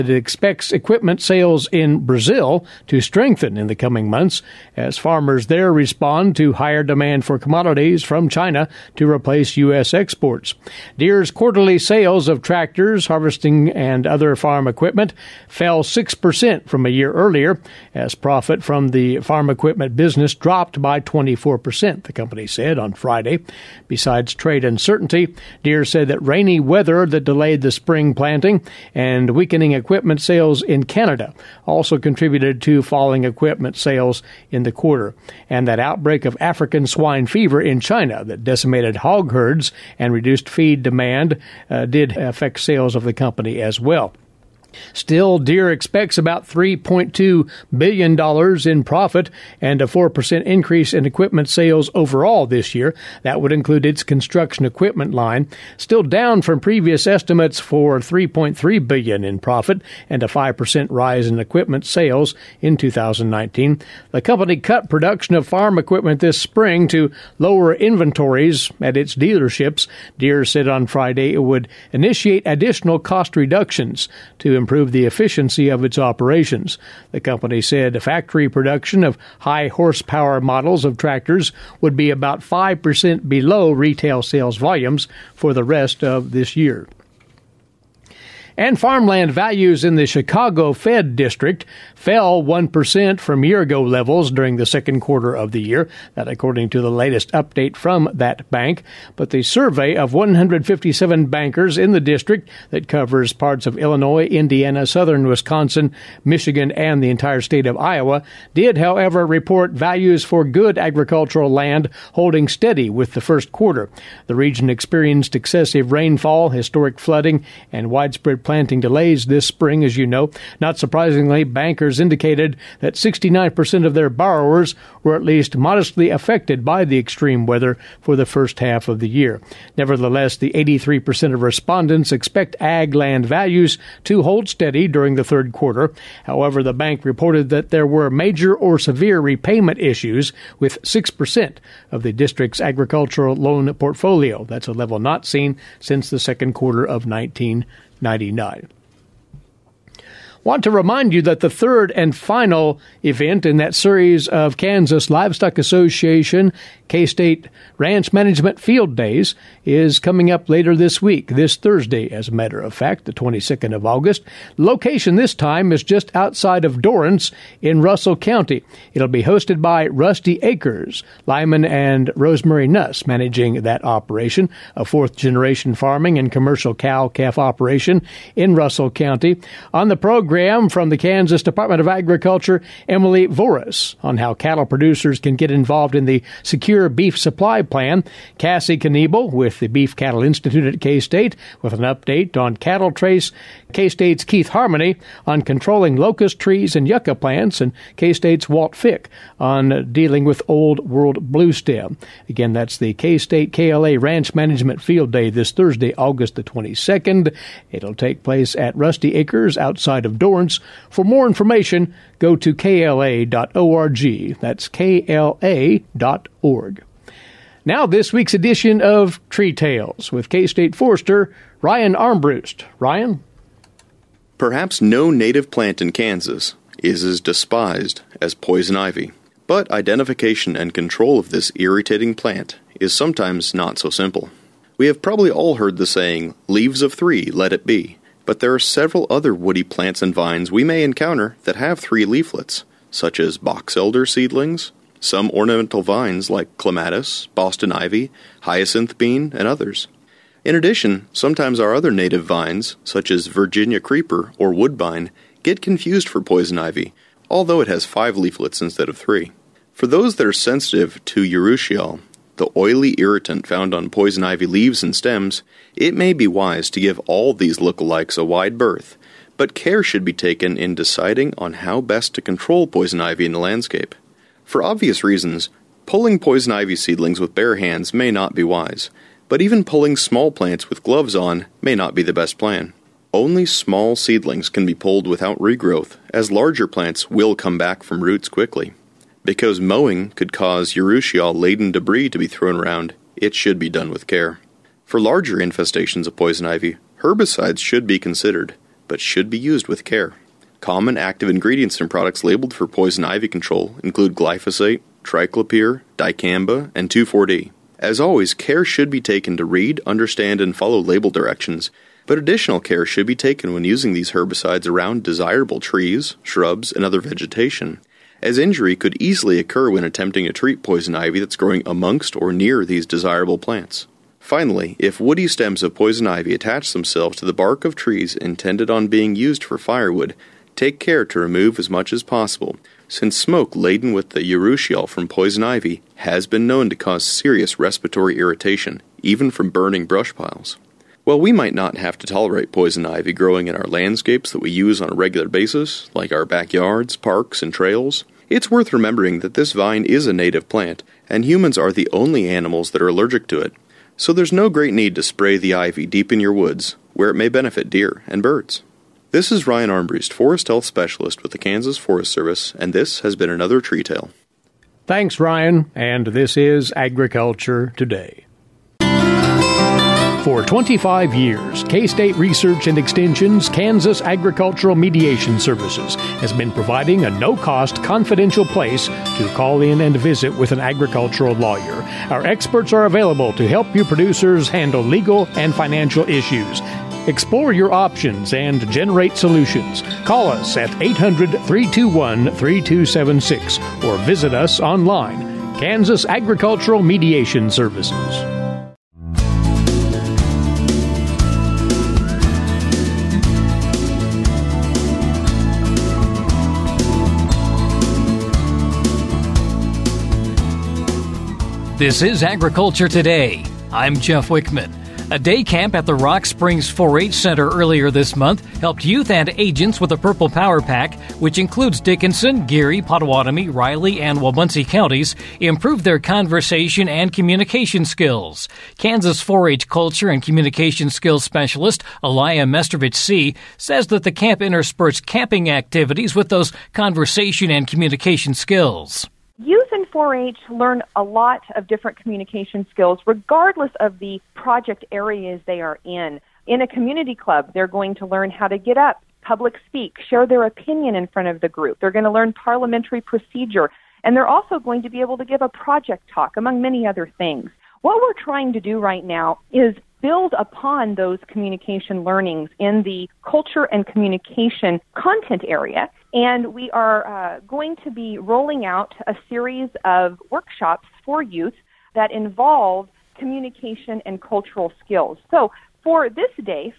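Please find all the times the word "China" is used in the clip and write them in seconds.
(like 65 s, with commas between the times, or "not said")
8 s, 37 s.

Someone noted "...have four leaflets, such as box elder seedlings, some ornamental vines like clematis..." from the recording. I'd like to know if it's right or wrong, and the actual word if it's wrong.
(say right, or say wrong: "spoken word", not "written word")
wrong: "three", not "four".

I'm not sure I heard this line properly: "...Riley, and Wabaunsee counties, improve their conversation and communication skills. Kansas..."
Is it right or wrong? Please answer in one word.
right.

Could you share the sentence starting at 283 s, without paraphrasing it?
Only small seedlings can be pulled without regrowth, as larger plants will come back from roots quickly.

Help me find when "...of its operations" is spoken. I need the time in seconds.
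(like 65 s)
75 s.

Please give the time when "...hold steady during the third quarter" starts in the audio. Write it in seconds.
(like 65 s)
134 s.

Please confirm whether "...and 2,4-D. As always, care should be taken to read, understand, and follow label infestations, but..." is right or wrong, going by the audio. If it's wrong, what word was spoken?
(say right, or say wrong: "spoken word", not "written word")
wrong: "directions", not "infestations".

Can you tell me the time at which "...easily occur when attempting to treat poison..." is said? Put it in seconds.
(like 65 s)
319 s.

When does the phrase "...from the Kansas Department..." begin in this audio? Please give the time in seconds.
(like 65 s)
180 s.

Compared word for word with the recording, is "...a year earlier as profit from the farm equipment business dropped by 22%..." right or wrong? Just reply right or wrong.
wrong.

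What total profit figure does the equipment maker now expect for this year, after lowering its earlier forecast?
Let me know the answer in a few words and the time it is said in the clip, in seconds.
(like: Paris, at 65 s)
$3.2 billion, at 46 s.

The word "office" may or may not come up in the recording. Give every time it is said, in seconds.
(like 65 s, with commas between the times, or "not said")
not said.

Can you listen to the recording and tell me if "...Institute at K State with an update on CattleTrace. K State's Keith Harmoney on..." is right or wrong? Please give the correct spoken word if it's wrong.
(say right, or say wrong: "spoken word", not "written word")
right.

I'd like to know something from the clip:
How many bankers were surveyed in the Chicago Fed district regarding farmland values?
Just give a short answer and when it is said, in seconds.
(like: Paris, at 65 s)
157, at 100 s.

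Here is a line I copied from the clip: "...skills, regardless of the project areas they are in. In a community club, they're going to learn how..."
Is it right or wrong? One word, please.
right.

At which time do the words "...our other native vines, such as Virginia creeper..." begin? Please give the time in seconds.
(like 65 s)
251 s.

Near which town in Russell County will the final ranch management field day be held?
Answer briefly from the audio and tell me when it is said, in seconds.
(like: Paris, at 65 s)
Dorrance, at 166 s.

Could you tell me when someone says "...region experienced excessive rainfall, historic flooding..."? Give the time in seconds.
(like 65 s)
114 s.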